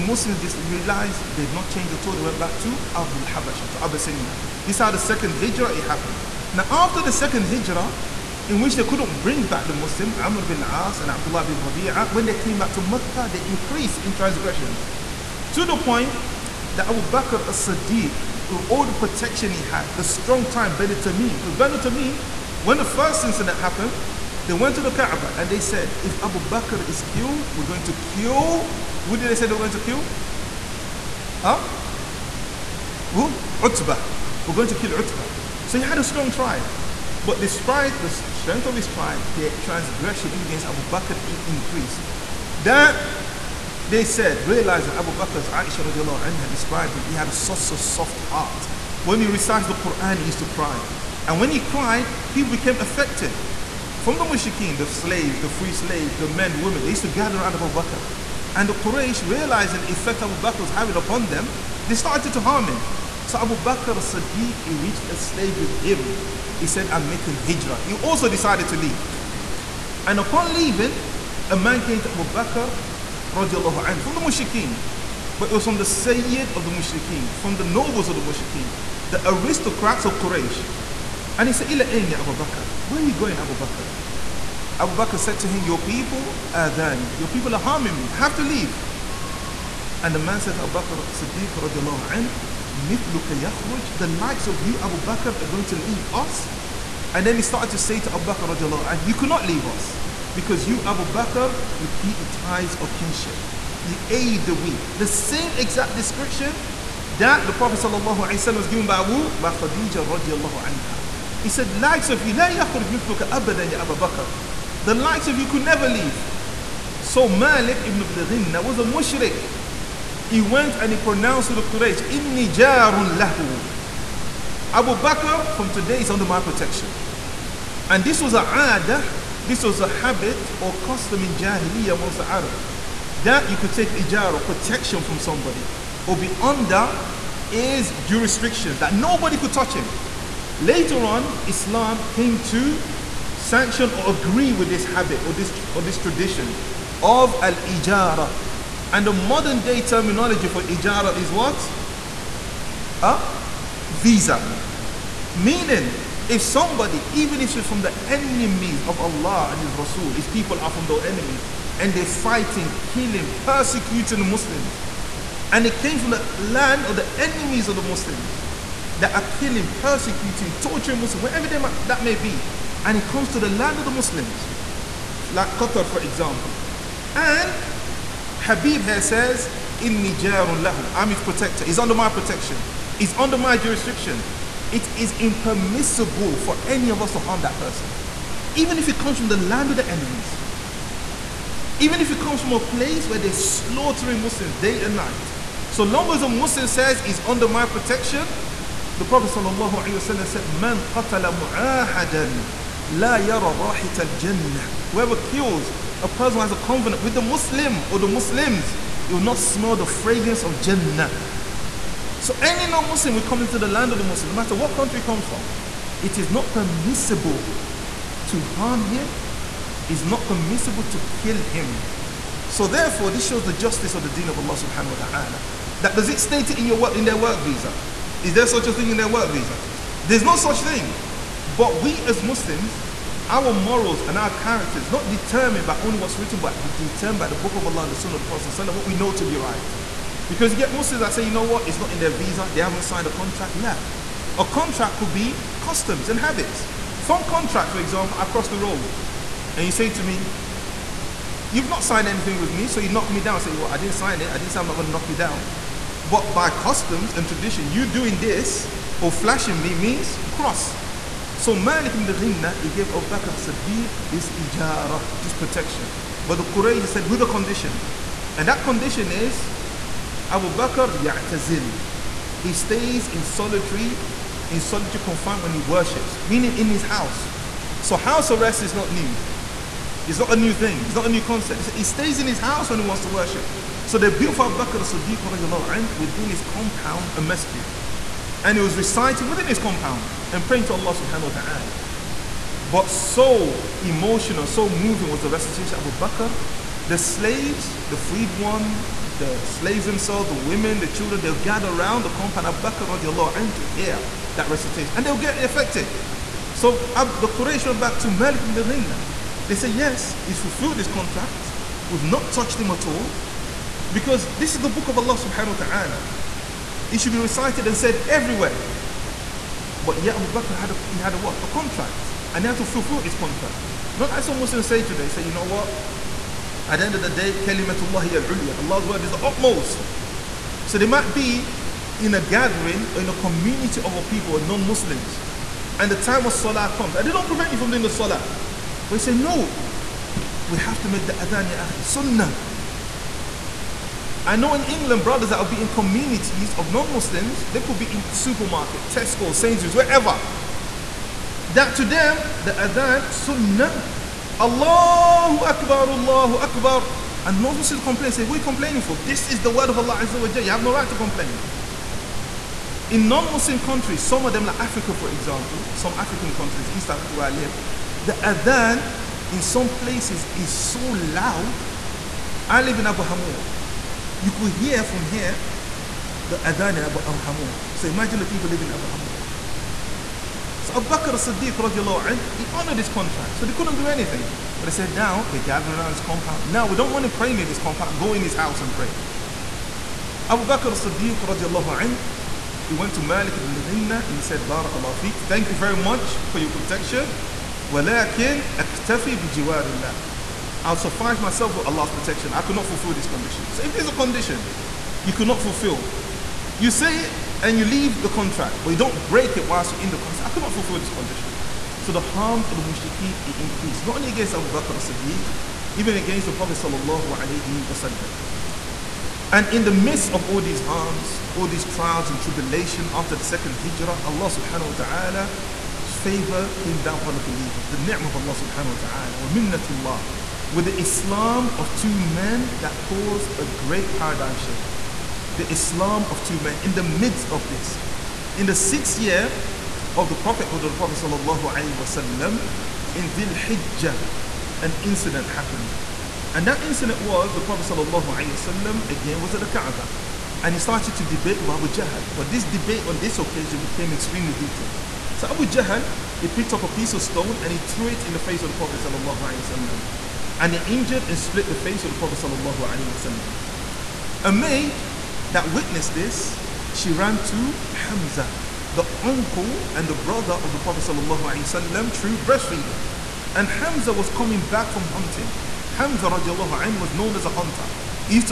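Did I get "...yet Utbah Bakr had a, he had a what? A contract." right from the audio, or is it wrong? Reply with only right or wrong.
wrong.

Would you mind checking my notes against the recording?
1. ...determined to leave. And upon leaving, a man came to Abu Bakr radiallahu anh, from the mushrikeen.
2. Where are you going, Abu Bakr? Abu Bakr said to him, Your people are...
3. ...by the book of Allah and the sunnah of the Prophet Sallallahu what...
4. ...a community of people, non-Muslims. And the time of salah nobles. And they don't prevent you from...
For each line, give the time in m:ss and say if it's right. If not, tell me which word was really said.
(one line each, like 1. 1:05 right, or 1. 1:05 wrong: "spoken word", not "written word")
1. 1:08 wrong: "decided", not "determined"
2. 1:22 right
3. 3:57 right
4. 5:33 wrong: "comes", not "nobles".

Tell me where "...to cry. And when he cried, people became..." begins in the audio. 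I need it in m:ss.
0:50.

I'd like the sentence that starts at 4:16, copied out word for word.
But by customs and tradition, you doing this or flashing me means cross.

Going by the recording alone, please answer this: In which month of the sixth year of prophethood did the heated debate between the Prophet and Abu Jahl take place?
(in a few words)
Dhil Hijjah.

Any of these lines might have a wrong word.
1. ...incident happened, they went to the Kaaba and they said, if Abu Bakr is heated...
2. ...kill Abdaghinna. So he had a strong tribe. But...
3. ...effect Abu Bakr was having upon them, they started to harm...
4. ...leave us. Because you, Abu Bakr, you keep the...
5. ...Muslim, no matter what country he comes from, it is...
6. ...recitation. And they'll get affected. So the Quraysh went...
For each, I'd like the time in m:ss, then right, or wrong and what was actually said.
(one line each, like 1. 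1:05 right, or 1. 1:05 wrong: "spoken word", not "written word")
1. 0:23 wrong: "killed", not "heated"
2. 0:34 wrong: "Utbah", not "Abdaghinna"
3. 0:59 right
4. 1:39 right
5. 3:34 right
6. 5:04 right.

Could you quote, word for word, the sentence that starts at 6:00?
You have no right to complain.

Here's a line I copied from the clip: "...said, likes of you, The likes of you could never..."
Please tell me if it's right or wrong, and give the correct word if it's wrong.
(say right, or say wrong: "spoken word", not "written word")
right.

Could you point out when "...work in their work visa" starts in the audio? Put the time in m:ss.
3:46.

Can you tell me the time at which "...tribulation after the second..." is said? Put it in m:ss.
7:02.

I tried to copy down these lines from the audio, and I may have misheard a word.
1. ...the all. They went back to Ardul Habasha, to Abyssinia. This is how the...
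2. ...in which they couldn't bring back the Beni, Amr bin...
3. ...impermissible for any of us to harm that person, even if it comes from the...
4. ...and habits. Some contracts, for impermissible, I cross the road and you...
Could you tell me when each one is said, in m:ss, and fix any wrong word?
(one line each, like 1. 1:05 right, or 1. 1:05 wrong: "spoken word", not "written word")
1. 0:01 right
2. 0:08 wrong: "Muslim", not "Beni"
3. 3:05 right
4. 4:06 wrong: "example", not "impermissible".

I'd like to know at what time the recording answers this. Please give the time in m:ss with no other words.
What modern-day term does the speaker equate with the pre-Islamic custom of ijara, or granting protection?
2:33.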